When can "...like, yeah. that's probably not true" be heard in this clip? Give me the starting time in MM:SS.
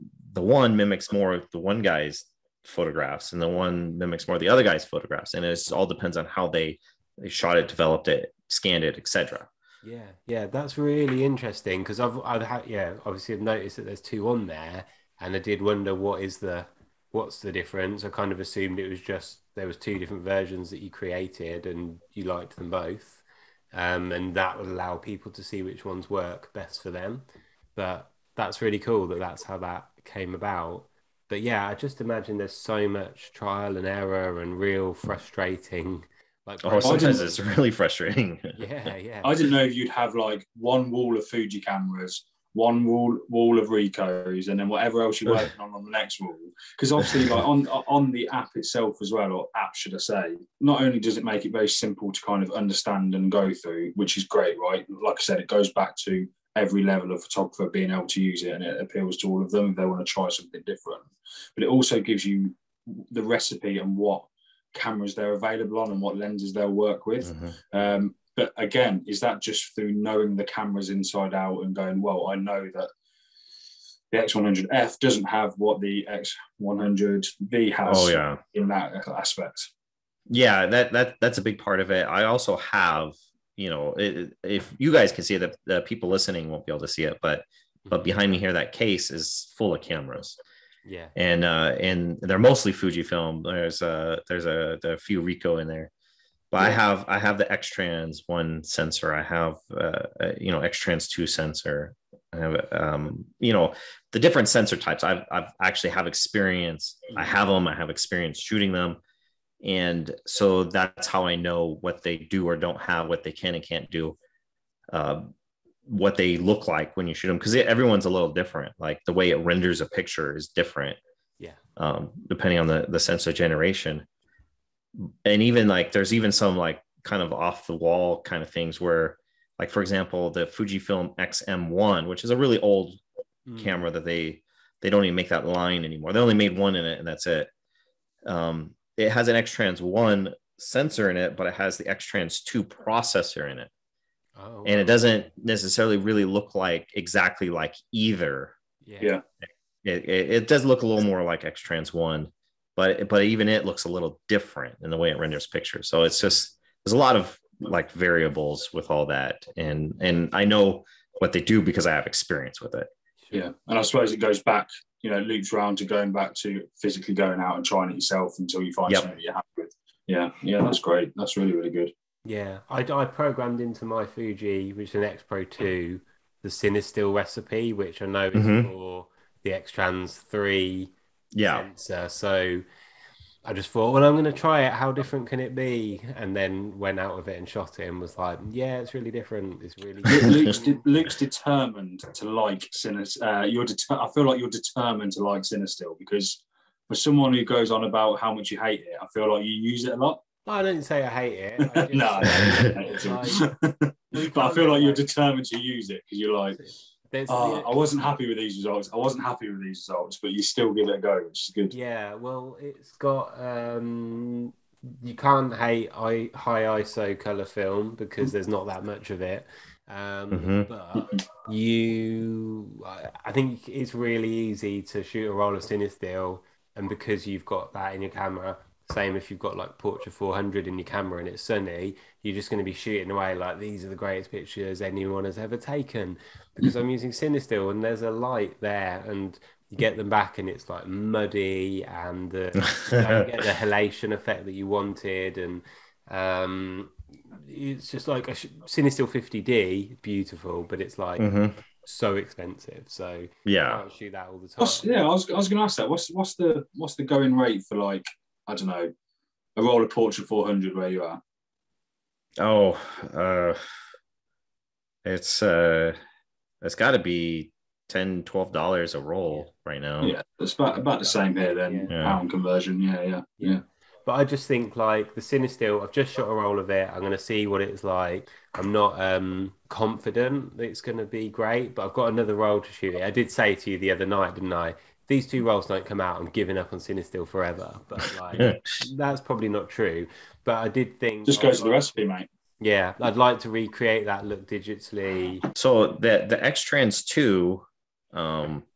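04:48.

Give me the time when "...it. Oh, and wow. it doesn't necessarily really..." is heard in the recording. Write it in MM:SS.
02:23.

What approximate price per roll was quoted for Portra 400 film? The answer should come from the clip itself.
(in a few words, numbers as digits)
$10.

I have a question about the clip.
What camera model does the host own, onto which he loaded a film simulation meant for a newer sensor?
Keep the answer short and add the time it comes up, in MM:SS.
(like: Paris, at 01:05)
X Pro 2, at 02:55.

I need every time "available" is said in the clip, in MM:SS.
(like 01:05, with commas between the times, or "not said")
01:05.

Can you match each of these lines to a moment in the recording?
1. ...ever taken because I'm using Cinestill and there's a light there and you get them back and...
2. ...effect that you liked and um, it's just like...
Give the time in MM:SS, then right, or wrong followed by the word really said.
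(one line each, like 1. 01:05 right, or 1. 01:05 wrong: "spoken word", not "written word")
1. 03:55 right
2. 04:04 wrong: "wanted", not "liked".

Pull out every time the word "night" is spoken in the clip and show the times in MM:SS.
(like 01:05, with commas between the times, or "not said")
04:44.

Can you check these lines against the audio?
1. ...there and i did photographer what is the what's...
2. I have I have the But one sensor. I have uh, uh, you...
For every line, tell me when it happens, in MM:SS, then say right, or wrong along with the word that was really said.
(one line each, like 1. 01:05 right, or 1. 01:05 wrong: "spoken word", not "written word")
1. 00:14 wrong: "wonder", not "photographer"
2. 01:36 wrong: "Xtrans", not "But".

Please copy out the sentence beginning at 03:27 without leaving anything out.
Uh, I wasn't happy with these results.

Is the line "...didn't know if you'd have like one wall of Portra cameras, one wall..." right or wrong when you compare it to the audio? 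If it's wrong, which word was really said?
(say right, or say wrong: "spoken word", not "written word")
wrong: "Fuji", not "Portra".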